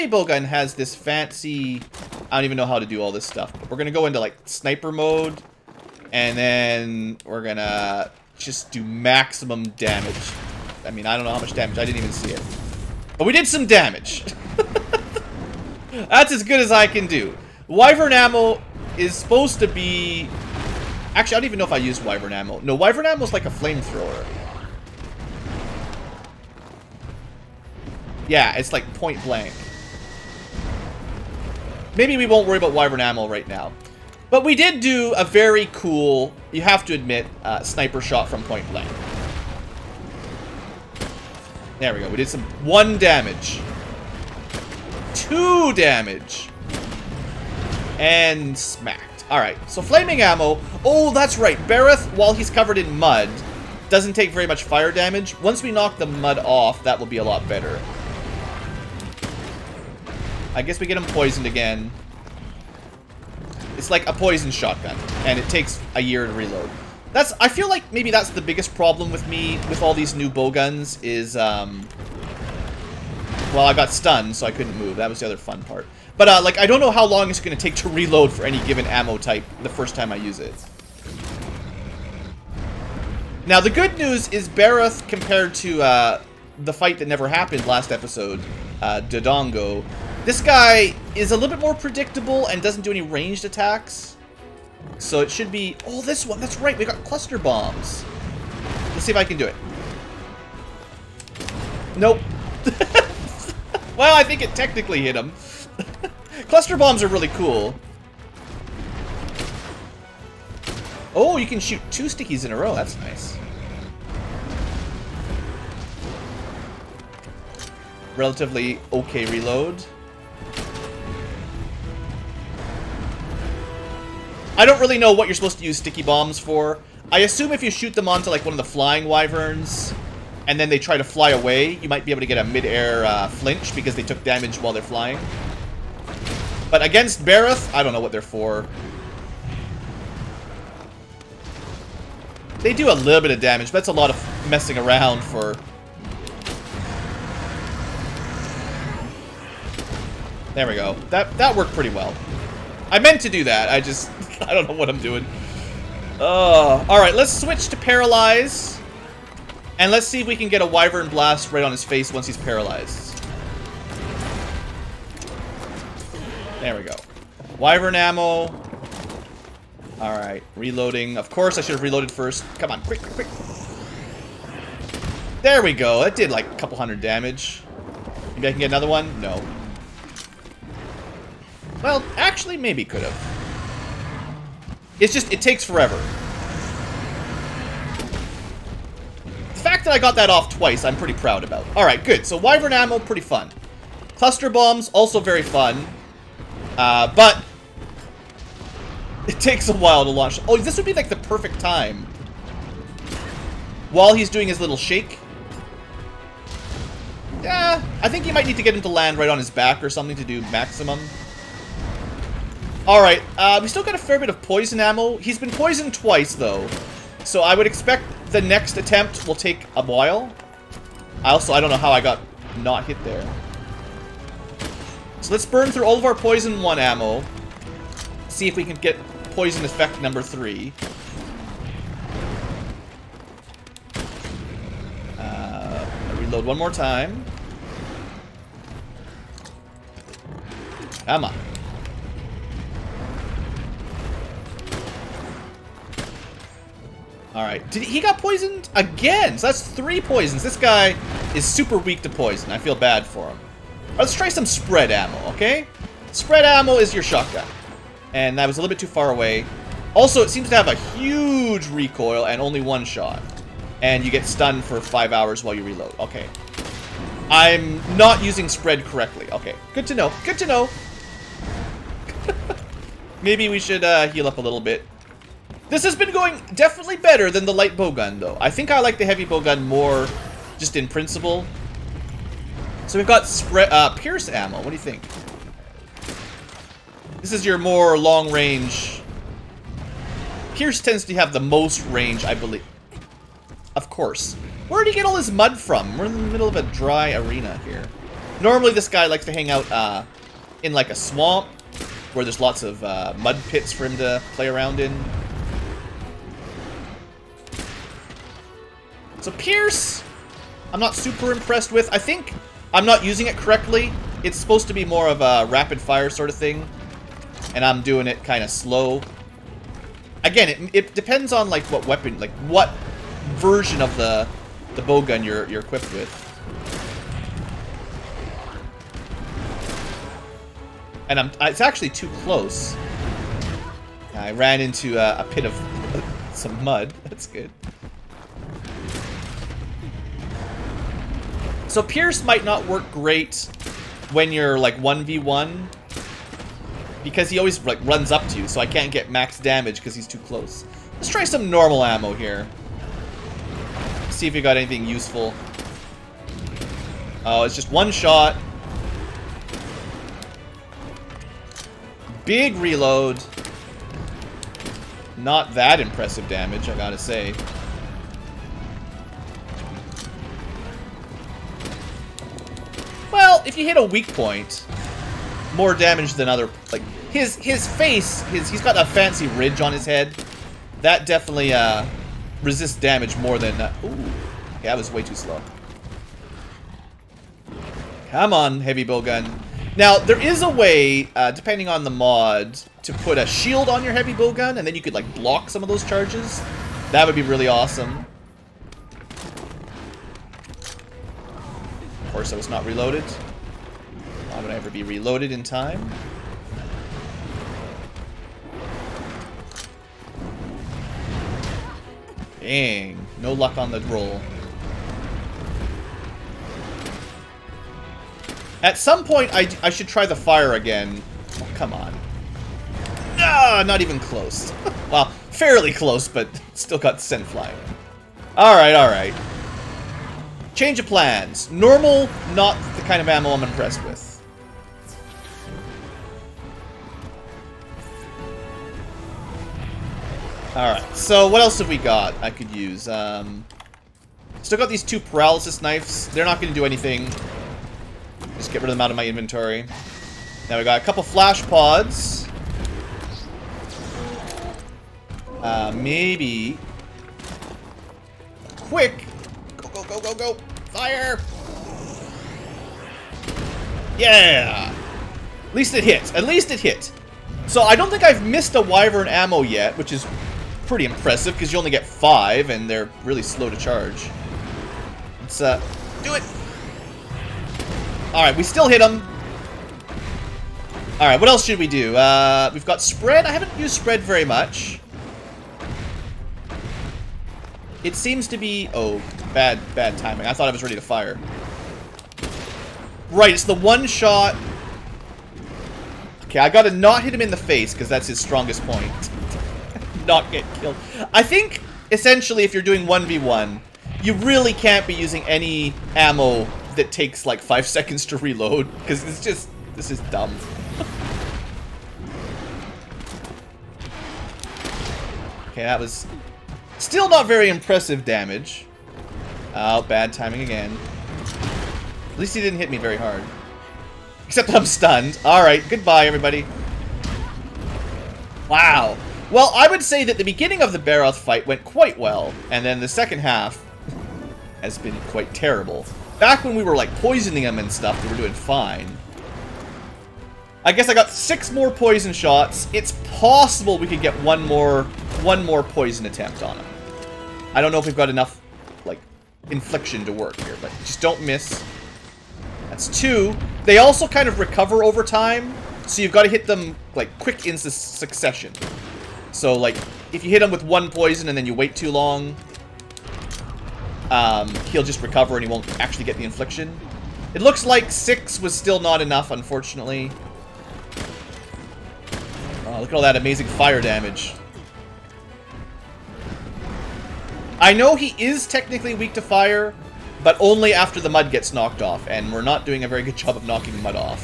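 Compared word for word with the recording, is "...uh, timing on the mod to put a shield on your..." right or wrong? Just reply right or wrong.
wrong.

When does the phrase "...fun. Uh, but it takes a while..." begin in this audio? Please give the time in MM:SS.
03:15.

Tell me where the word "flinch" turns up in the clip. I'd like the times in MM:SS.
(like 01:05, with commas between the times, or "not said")
02:13.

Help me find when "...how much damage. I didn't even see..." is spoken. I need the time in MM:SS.
00:11.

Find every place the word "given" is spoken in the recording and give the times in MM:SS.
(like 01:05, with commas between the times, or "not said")
01:18.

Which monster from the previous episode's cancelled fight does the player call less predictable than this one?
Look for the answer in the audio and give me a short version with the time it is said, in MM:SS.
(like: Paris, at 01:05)
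Dodongo, at 01:29.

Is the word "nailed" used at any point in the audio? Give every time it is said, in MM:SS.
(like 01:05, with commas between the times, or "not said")
not said.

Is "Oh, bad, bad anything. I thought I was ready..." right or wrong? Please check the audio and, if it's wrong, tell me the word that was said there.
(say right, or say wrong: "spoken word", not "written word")
wrong: "timing", not "anything".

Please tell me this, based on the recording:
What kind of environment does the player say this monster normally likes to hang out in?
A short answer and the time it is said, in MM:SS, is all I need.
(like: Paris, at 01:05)
A swamp, at 05:00.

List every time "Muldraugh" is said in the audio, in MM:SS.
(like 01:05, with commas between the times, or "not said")
not said.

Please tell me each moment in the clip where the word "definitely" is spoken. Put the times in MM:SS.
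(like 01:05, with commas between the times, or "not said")
04:36, 06:21.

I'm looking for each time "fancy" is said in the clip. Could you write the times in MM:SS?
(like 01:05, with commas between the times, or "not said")
00:00, 06:18.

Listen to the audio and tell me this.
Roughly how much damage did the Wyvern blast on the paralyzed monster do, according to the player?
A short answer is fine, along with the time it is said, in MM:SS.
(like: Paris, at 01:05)
A couple hundred, at 02:56.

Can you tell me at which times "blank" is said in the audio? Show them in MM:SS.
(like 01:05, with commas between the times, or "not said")
00:29, 00:38.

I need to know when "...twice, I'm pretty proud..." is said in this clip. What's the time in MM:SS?
03:10.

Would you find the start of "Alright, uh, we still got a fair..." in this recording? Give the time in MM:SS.
03:32.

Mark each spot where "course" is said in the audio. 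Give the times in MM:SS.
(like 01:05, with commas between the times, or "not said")
02:51, 04:53, 06:42.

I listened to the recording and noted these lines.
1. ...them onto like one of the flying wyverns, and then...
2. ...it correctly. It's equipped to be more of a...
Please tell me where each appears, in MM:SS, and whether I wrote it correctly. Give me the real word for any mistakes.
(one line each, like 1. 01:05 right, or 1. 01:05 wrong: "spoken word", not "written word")
1. 02:07 right
2. 05:13 wrong: "supposed", not "equipped".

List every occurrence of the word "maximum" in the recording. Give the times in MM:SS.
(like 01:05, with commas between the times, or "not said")
00:08, 03:30.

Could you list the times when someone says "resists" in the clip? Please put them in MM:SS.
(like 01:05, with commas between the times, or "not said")
06:22.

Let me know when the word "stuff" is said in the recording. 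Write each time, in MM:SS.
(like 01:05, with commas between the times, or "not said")
00:03, 08:57.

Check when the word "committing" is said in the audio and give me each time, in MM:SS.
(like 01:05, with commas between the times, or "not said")
not said.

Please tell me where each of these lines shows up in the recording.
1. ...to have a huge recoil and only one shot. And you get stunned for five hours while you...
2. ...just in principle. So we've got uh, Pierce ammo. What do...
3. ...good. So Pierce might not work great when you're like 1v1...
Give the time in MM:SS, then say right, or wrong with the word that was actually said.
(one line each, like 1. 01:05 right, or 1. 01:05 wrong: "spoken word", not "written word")
1. 04:20 right
2. 04:40 right
3. 05:37 right.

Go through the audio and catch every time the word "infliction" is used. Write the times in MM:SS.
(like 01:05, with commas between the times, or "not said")
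09:09, 09:26.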